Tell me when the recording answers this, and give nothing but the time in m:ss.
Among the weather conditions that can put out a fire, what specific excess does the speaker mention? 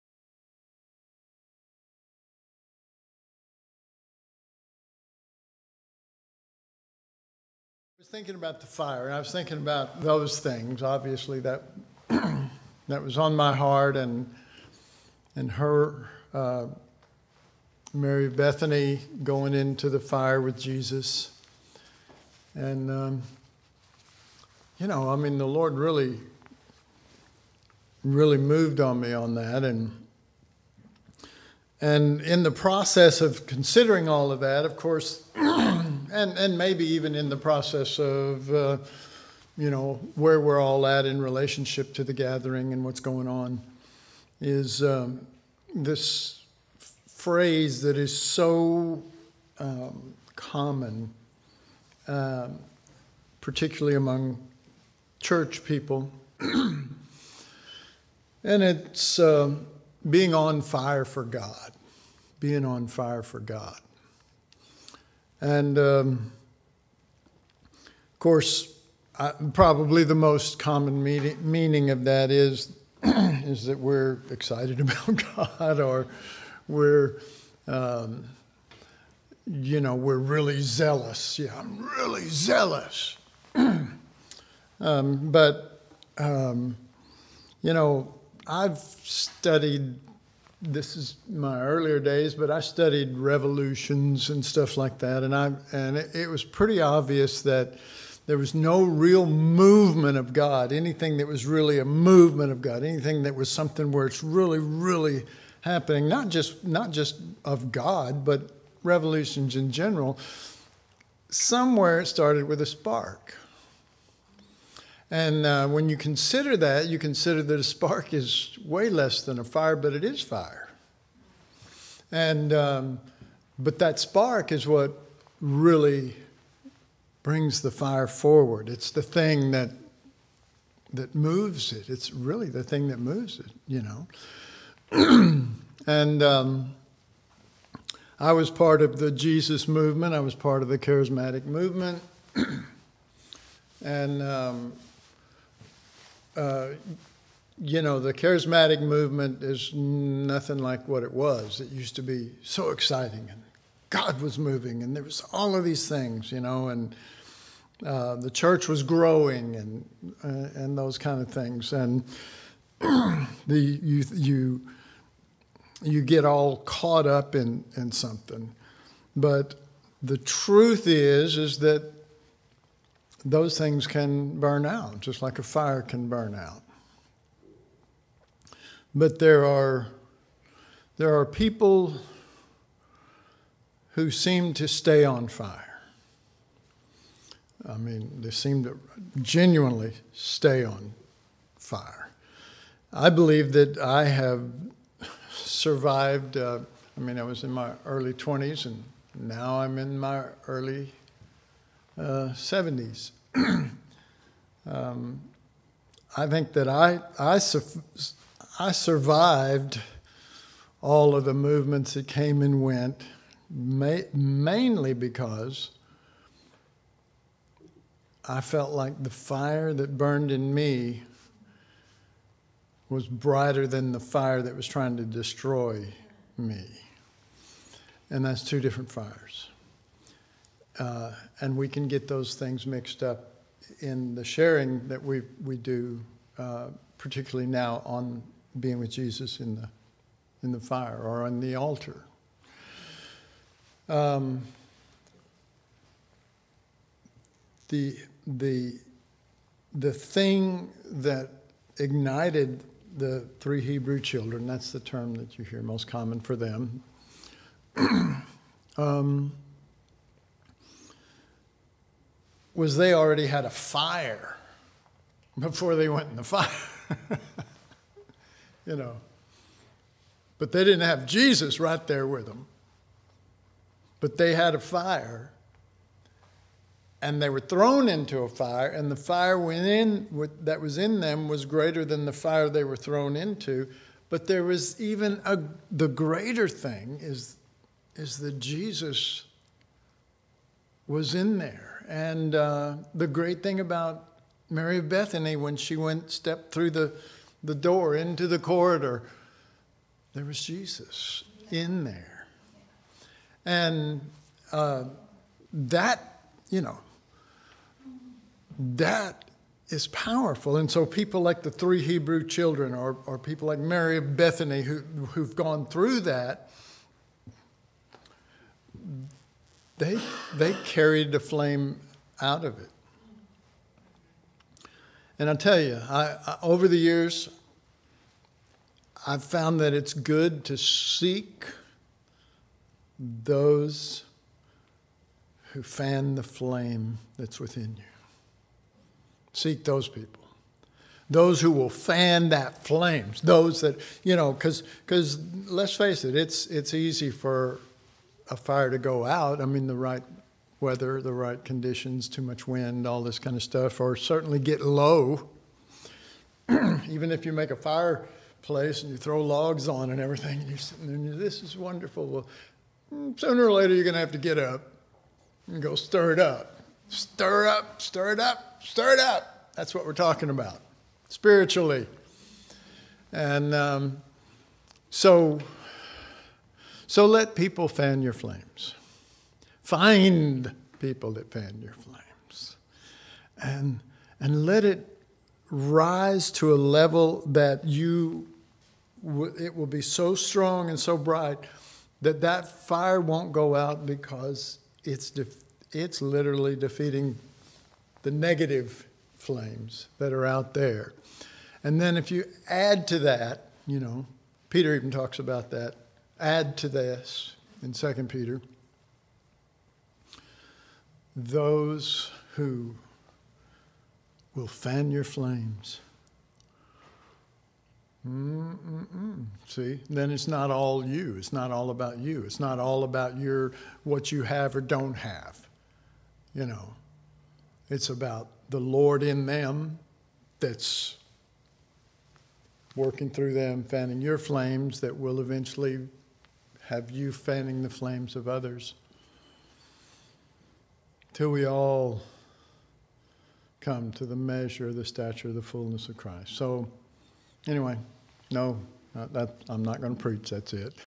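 5:52.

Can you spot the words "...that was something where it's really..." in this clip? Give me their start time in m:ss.
1:43.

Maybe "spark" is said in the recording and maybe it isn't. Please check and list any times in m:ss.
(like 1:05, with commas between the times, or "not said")
1:52, 1:57, 2:03.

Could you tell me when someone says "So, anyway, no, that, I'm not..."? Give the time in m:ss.
7:26.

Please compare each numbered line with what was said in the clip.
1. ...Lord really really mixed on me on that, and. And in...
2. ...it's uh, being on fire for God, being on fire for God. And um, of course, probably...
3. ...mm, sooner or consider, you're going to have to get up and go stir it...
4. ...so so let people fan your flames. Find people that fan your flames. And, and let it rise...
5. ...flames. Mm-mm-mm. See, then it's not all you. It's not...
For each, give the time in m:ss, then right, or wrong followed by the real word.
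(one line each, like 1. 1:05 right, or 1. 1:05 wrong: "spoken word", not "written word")
1. 0:25 wrong: "moved", not "mixed"
2. 0:58 right
3. 6:02 wrong: "later", not "consider"
4. 6:14 right
5. 6:55 right.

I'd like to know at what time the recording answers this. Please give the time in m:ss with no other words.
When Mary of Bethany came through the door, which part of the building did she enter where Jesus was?
4:58.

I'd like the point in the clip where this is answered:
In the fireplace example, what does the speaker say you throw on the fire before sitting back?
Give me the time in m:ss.
5:59.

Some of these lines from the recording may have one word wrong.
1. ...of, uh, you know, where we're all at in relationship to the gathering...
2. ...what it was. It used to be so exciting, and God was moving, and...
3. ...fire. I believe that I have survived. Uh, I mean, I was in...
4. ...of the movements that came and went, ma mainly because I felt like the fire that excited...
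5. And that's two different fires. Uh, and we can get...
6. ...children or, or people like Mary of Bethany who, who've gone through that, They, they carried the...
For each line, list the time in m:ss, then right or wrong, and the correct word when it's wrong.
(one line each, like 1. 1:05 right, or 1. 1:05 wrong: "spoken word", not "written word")
1. 0:37 right
2. 2:30 right
3. 3:11 right
4. 3:31 wrong: "burned", not "excited"
5. 3:48 right
6. 5:12 right.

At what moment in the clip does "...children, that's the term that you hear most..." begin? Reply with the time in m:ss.
4:13.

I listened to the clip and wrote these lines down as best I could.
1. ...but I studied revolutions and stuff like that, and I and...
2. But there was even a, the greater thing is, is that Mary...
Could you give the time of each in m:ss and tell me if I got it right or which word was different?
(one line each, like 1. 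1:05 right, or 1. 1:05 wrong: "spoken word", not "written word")
1. 1:32 right
2. 4:44 wrong: "Jesus", not "Mary".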